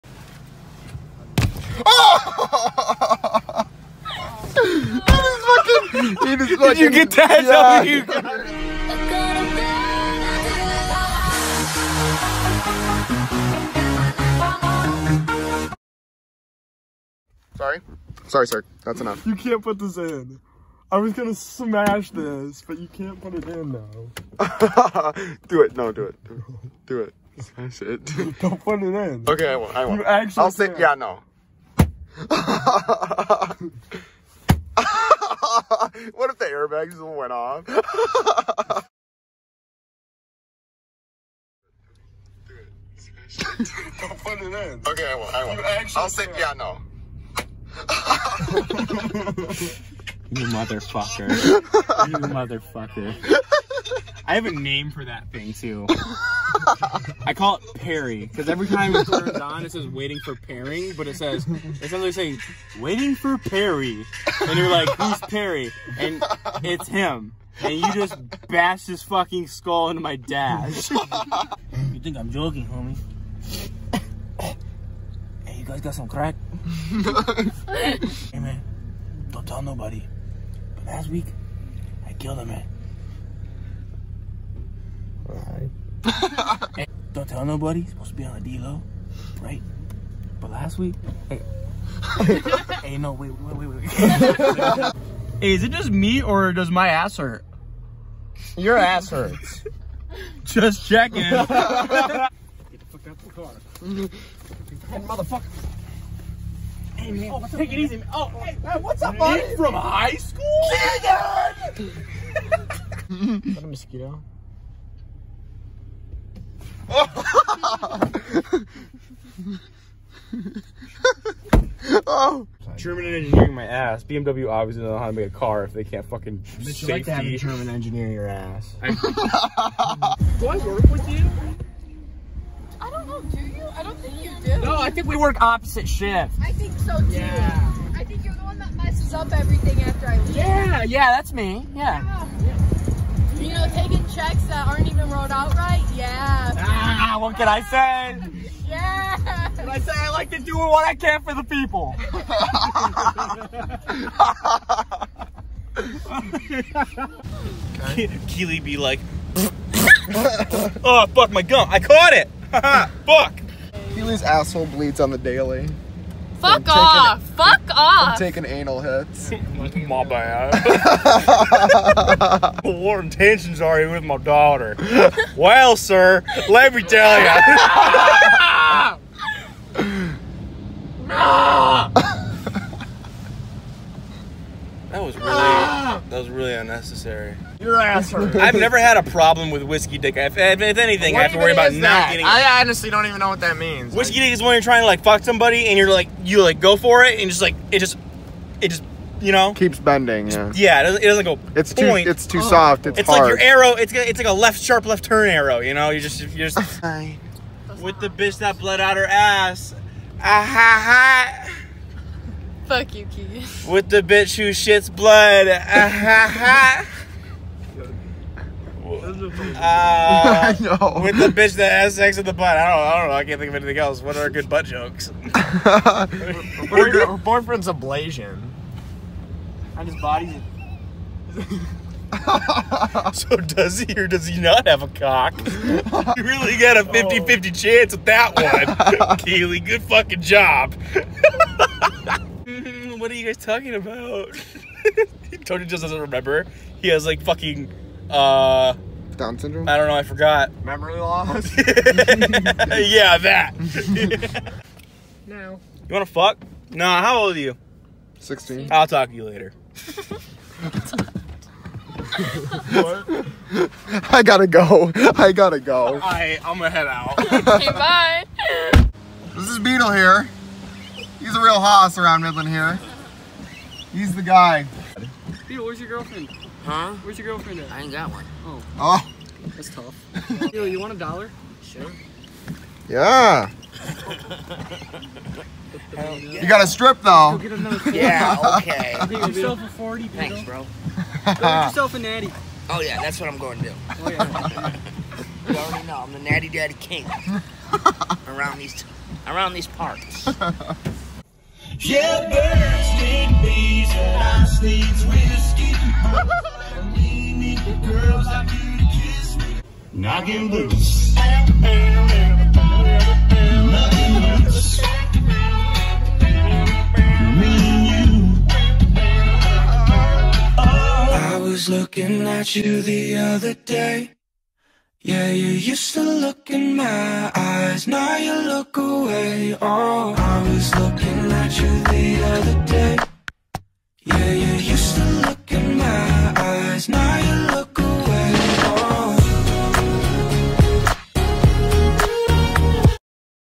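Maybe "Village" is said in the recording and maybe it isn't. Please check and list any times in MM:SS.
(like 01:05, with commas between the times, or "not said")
not said.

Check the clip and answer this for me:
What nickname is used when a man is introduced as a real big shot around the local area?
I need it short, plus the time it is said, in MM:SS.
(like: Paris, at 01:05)
Beetle, at 04:29.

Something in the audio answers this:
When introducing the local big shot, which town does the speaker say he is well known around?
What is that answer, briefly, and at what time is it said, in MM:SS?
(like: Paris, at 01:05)
Midland, at 04:32.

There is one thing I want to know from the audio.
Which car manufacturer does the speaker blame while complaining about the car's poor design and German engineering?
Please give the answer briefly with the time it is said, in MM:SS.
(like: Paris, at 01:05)
BMW, at 02:04.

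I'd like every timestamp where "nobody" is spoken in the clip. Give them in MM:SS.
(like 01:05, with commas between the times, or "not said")
01:19, 01:27.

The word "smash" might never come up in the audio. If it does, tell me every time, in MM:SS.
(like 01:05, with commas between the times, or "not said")
00:21, 00:27.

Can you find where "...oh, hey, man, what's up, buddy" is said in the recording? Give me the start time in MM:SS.
01:48.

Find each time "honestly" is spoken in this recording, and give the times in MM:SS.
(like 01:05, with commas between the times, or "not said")
03:12.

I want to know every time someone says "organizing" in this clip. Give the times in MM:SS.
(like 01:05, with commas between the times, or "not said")
not said.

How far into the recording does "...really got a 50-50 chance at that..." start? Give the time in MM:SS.
03:56.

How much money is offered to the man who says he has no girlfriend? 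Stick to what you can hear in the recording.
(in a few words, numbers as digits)
1 dollar.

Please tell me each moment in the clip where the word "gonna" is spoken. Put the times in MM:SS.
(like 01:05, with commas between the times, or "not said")
00:21, 04:26.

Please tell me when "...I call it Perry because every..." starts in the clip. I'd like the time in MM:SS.
00:57.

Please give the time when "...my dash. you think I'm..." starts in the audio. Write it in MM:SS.
01:10.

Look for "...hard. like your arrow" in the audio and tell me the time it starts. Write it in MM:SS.
03:23.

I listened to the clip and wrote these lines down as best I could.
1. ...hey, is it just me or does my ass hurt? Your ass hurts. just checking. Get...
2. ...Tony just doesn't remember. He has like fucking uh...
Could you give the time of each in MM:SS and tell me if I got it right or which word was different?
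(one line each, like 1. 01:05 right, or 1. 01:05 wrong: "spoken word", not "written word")
1. 01:33 right
2. 04:05 right.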